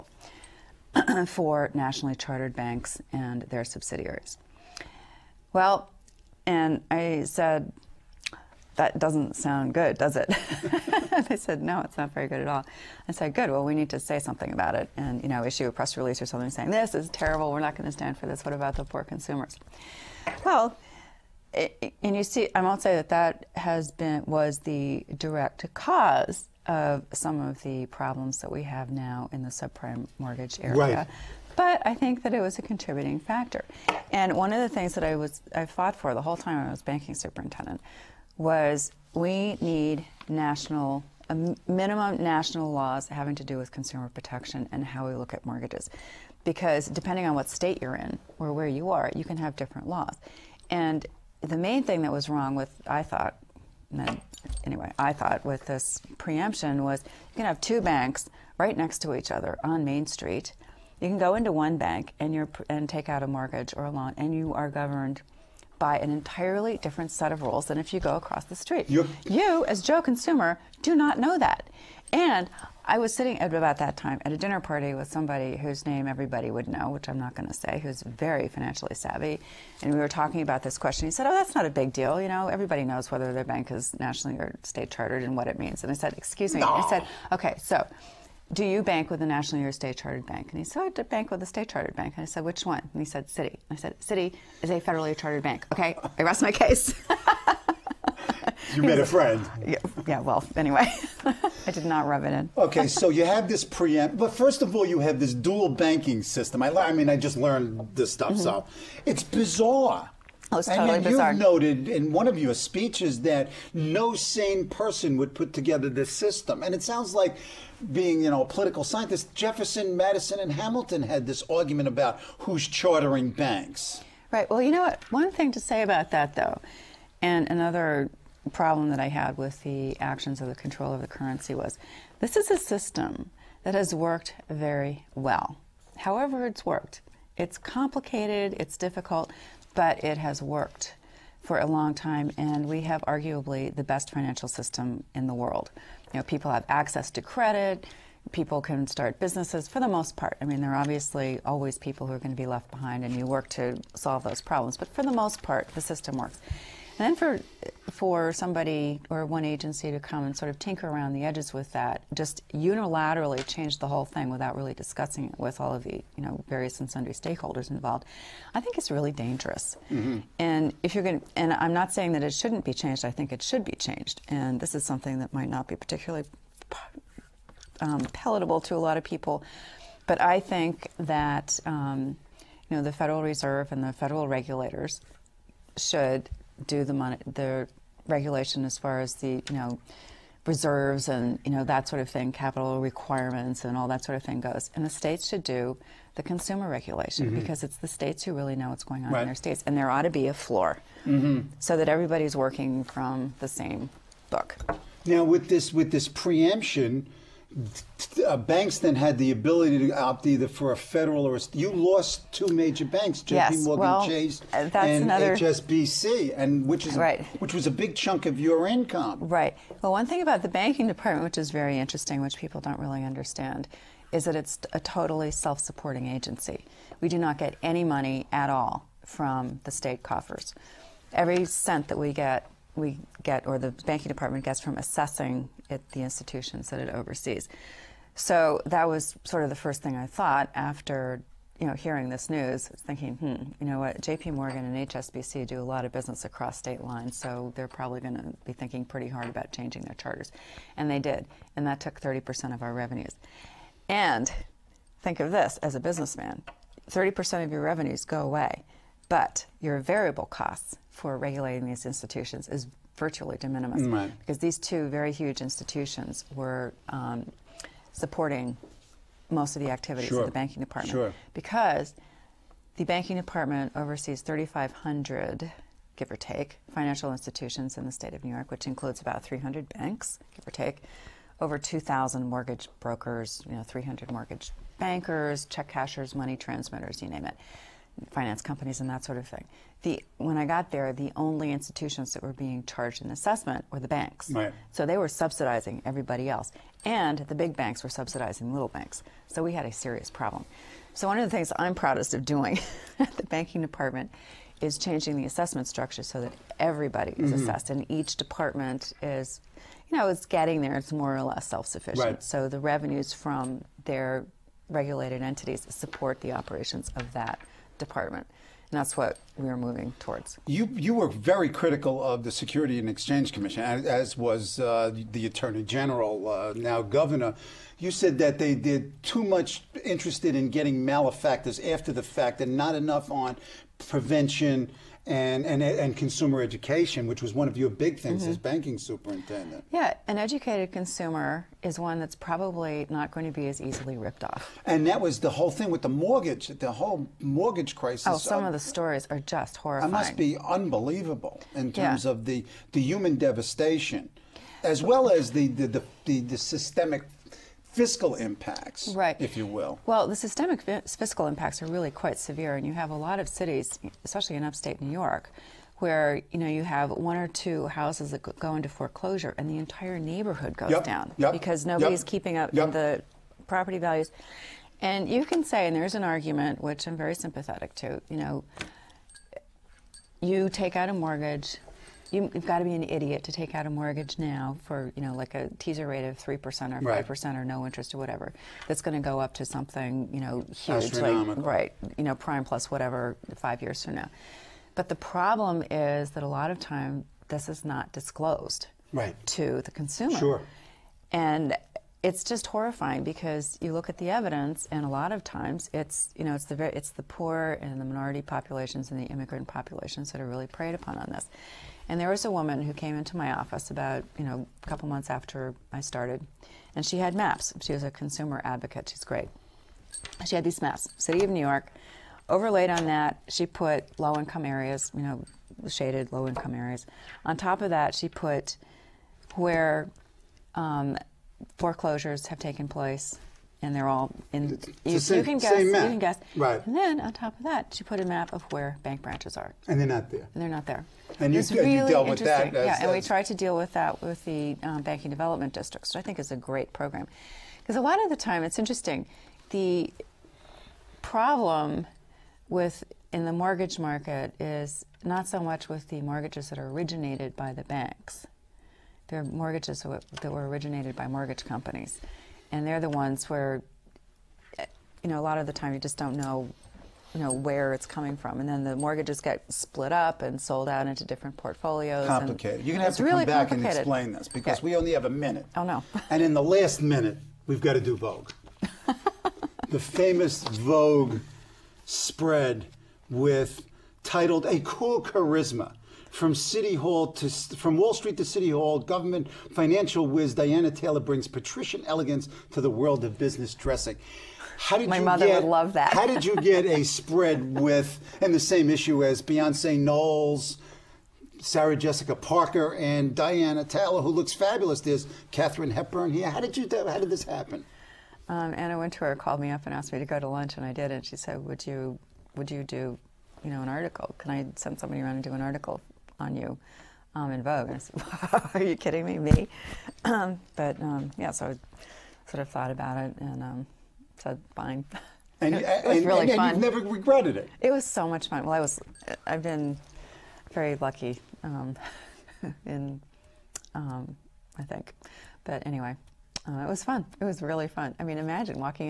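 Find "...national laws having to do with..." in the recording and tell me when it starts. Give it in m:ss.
0:42.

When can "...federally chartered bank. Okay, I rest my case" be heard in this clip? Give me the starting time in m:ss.
1:34.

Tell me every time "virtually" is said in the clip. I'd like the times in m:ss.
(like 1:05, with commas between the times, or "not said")
4:22.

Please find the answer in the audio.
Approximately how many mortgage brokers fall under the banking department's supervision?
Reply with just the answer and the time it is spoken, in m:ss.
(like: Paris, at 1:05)
over 2000, at 4:41.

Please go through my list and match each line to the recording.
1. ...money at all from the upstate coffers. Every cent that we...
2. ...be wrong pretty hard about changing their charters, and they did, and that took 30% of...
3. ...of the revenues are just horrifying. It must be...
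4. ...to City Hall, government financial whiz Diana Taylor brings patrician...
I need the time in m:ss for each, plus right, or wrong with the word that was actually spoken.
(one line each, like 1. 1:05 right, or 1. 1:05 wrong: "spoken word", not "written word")
1. 3:47 wrong: "state", not "upstate"
2. 4:08 wrong: "thinking", not "wrong"
3. 5:48 wrong: "stories", not "revenues"
4. 8:08 right.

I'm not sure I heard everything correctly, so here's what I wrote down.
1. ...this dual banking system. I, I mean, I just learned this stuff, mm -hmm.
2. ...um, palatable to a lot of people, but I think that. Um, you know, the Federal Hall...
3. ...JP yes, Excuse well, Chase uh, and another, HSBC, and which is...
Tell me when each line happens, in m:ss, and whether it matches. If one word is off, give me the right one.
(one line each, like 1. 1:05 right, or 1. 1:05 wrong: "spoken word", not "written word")
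1. 1:45 right
2. 2:57 wrong: "Reserve", not "Hall"
3. 3:33 wrong: "Morgan", not "Excuse".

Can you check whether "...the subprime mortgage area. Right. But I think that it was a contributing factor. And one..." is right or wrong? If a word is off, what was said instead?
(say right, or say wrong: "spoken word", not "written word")
right.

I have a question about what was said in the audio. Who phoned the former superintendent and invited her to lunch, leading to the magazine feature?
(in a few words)
Anna Wintour.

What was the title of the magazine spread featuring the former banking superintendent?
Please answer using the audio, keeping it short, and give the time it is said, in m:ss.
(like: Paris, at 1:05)
A Cool Charisma, at 8:04.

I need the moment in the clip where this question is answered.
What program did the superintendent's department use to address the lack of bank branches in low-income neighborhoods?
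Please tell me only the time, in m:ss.
7:24.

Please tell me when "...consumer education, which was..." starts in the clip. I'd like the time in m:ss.
5:35.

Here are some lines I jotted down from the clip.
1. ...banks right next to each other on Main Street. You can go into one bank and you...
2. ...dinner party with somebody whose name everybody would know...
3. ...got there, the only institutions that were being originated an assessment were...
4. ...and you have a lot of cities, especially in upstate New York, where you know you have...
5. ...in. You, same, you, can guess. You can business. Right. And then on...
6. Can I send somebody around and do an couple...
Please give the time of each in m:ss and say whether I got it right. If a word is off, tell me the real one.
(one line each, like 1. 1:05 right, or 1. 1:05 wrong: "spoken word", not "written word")
1. 0:57 right
2. 1:14 right
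3. 4:50 wrong: "charged", not "originated"
4. 6:02 right
5. 7:14 wrong: "guess", not "business"
6. 8:34 wrong: "article", not "couple".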